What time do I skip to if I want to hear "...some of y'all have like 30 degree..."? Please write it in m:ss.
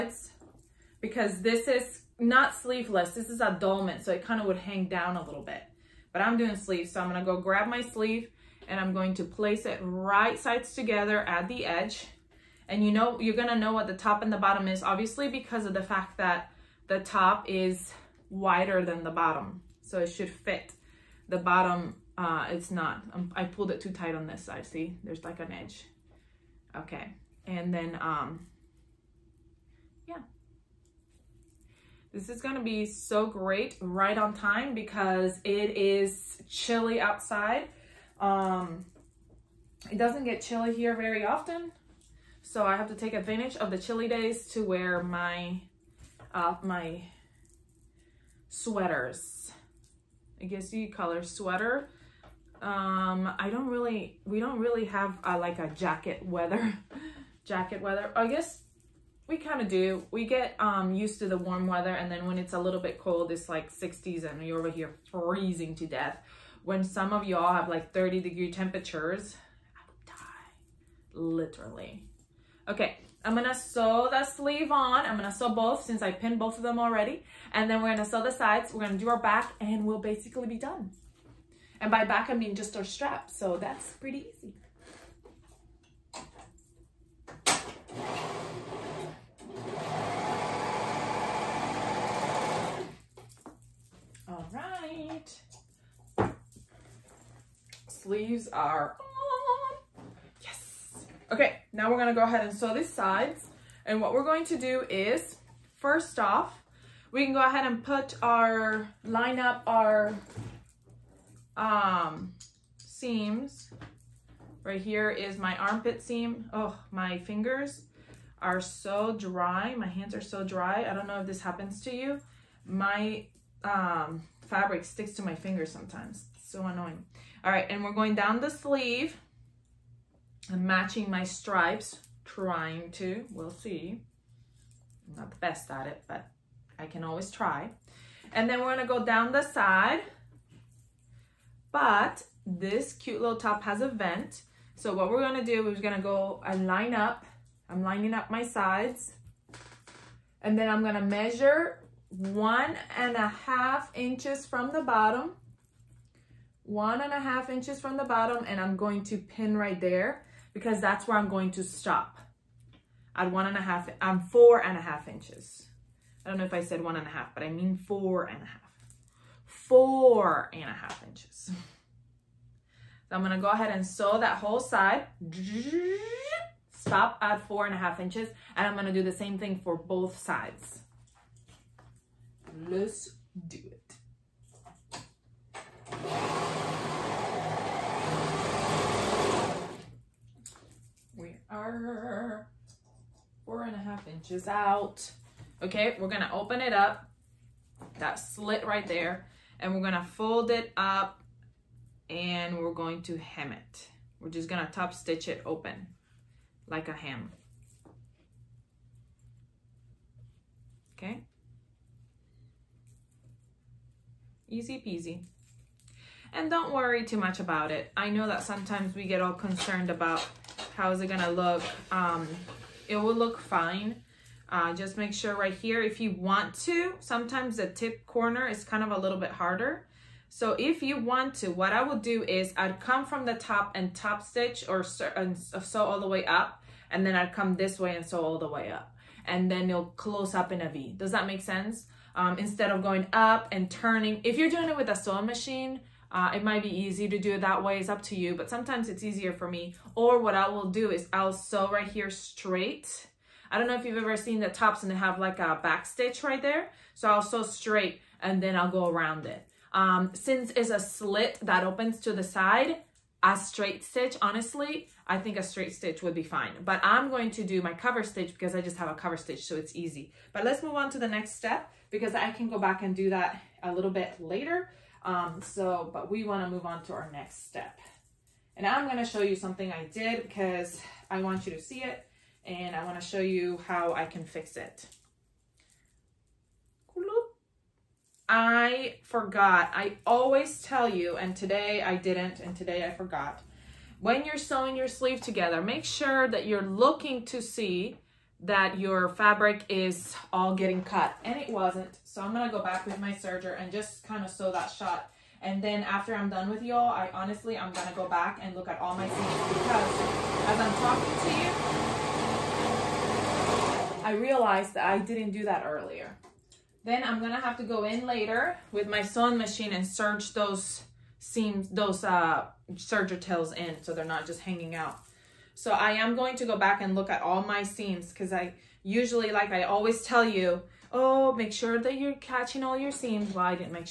1:06.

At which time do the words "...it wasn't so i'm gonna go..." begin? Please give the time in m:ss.
5:01.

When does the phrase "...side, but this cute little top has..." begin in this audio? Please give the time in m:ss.
2:19.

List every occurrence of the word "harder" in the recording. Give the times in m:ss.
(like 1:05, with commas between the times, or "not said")
3:49.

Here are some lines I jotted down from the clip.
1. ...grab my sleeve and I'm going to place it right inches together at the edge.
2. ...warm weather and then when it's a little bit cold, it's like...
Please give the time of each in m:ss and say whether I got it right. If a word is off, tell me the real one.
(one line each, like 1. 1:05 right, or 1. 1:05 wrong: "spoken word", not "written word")
1. 0:07 wrong: "sides", not "inches"
2. 1:01 right.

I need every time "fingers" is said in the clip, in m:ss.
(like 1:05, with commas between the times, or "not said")
1:57, 2:05.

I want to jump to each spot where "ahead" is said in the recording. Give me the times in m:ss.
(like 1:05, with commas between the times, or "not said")
1:42, 1:47, 2:53.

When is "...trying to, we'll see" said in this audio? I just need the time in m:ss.
2:12.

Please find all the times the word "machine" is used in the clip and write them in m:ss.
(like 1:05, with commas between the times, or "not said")
4:05, 5:19.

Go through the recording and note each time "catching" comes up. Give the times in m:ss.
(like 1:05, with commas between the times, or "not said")
5:32.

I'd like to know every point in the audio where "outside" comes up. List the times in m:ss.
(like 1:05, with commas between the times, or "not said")
0:36.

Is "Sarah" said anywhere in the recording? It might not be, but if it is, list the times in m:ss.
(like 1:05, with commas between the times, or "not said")
not said.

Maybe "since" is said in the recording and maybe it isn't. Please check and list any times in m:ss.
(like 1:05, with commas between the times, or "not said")
1:15, 4:20.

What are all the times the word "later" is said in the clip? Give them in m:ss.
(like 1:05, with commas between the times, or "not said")
4:34, 5:18.